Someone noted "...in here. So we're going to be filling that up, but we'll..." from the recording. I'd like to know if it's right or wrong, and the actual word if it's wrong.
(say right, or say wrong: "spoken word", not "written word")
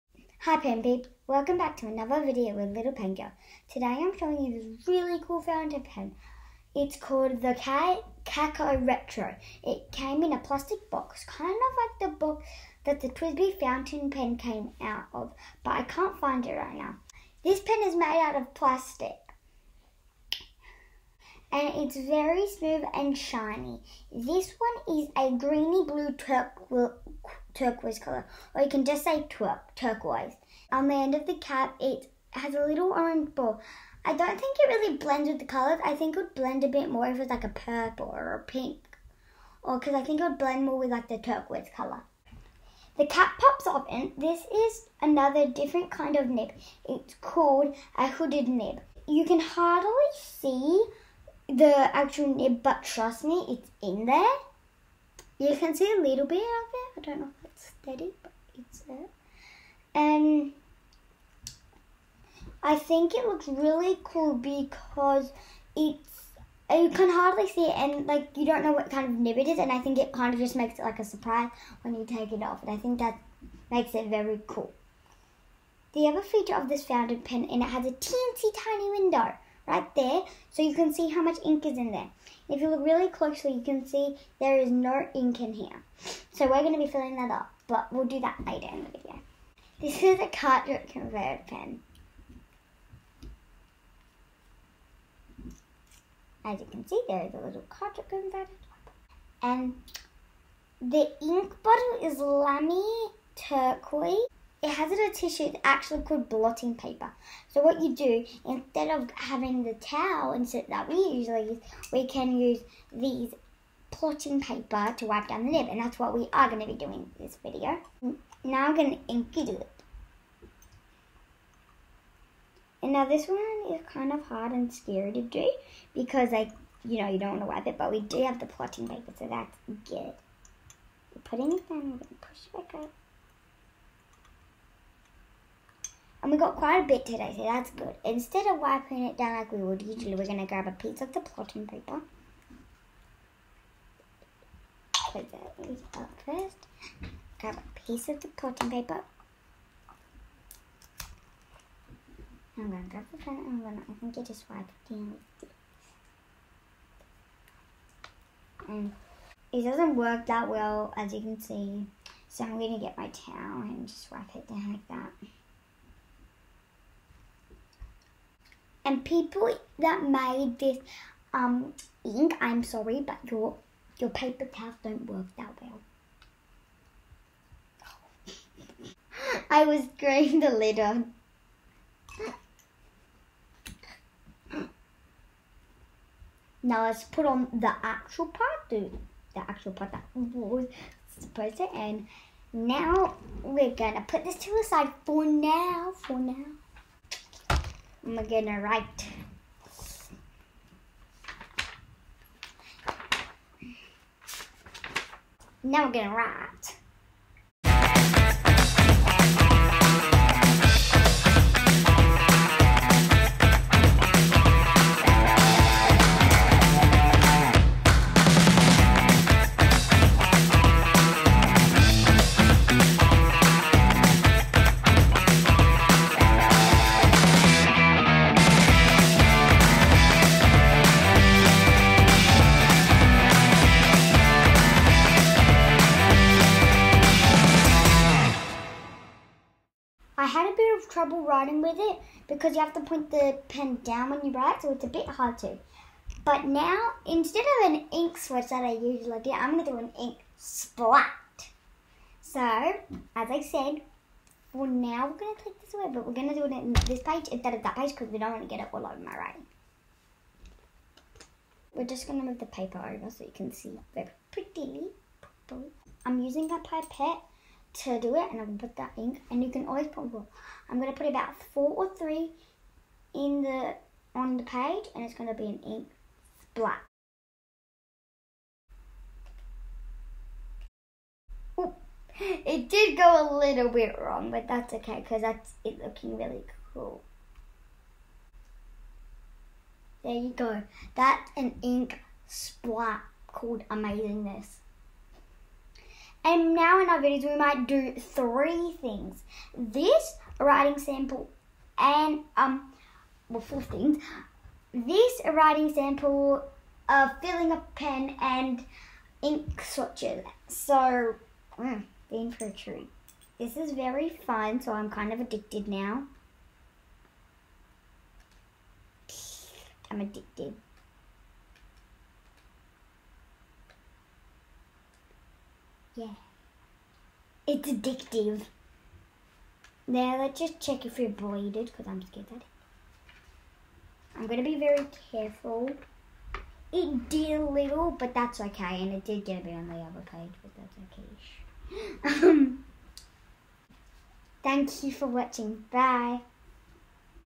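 right.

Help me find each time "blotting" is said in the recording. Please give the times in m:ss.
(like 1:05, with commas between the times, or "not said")
1:46, 1:53, 2:08, 2:21, 2:28.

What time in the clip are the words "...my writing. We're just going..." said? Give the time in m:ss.
4:19.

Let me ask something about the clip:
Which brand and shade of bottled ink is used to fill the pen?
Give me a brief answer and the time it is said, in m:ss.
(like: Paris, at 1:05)
Lamy Turquoise, at 1:42.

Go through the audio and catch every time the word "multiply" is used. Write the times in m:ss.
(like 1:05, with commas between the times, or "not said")
not said.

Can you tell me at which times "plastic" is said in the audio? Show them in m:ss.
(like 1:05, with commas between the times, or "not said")
0:10, 0:18.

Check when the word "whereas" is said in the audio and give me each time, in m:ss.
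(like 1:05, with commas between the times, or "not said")
not said.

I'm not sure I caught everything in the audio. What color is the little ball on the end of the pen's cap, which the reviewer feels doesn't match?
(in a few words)
Orange.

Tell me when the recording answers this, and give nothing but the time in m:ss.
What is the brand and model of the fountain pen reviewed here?
0:08.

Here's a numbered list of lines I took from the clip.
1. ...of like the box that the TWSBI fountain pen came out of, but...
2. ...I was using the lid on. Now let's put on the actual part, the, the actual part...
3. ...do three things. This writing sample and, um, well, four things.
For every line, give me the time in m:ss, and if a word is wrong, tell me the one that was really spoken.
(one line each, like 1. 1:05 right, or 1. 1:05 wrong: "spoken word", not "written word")
1. 0:11 right
2. 2:59 wrong: "growing", not "using"
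3. 4:57 right.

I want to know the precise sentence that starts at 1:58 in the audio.
Now I'm going to inky doodle it.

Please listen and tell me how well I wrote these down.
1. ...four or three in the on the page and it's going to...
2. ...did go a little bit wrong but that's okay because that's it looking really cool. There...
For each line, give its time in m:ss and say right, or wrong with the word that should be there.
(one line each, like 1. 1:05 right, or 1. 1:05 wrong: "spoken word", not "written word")
1. 4:31 right
2. 4:42 right.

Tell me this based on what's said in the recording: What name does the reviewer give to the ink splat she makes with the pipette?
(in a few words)
Amazingness.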